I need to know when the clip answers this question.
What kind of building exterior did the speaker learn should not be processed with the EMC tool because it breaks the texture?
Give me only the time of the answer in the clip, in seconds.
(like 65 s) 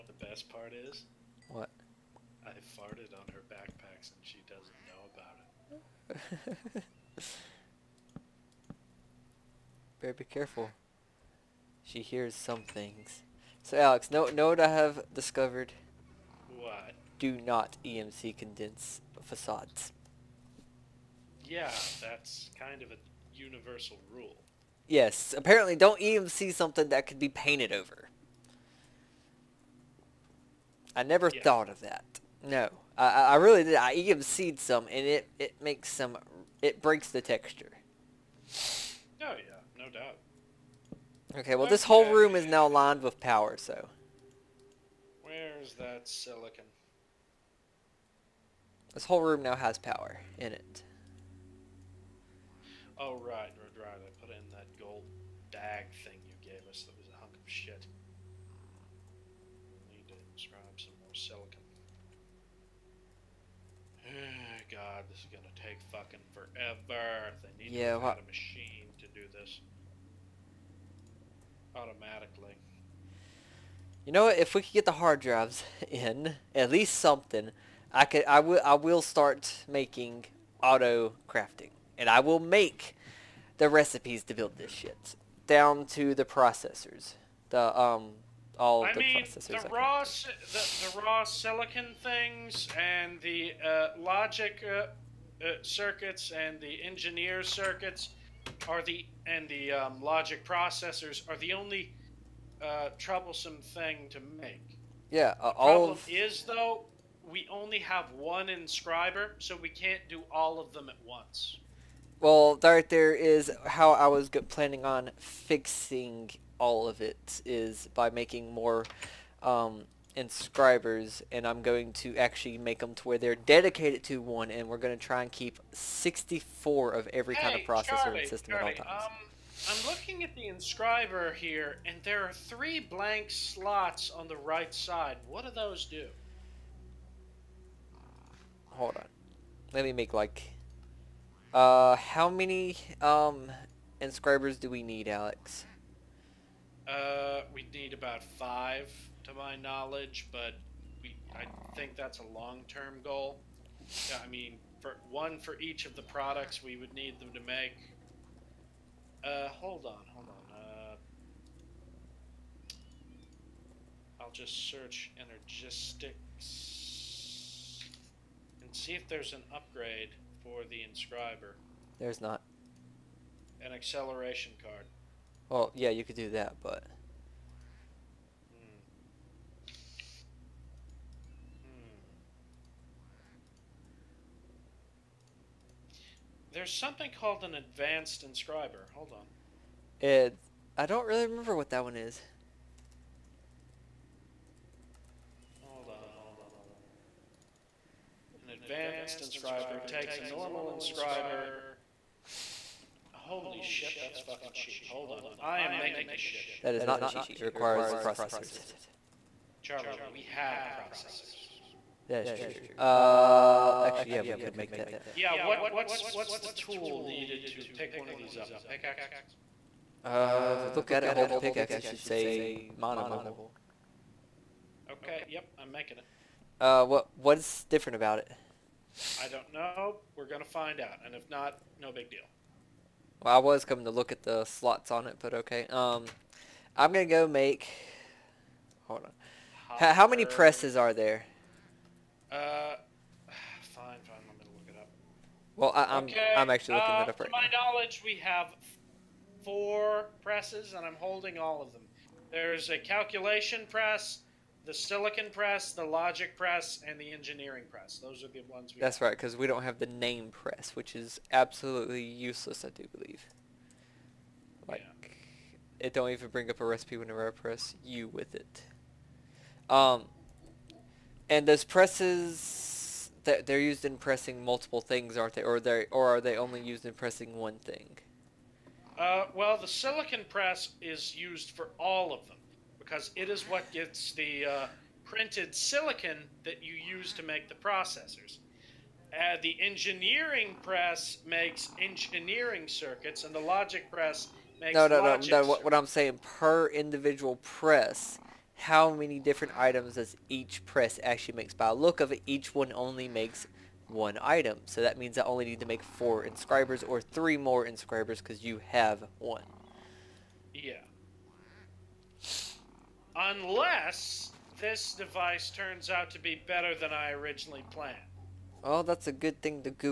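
19 s.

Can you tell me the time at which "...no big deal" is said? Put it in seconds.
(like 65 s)
231 s.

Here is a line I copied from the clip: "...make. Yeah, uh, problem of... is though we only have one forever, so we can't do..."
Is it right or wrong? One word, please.
wrong.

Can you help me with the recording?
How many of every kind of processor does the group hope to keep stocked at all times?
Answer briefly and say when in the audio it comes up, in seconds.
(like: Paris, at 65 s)
64, at 125 s.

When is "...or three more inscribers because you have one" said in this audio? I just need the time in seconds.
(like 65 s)
306 s.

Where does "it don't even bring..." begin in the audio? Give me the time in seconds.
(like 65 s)
265 s.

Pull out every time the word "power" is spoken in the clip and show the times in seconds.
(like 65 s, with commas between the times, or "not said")
43 s, 49 s.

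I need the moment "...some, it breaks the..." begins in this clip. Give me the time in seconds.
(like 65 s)
35 s.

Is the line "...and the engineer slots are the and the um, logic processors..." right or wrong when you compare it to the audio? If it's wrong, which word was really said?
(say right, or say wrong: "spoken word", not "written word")
wrong: "circuits", not "slots".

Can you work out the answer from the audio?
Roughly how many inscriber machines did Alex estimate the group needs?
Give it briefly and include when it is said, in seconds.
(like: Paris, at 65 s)
5, at 148 s.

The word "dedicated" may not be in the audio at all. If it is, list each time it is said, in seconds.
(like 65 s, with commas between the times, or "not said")
123 s.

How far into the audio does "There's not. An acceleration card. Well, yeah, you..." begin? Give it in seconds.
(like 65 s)
171 s.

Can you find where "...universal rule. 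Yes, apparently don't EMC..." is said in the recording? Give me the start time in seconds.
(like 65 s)
23 s.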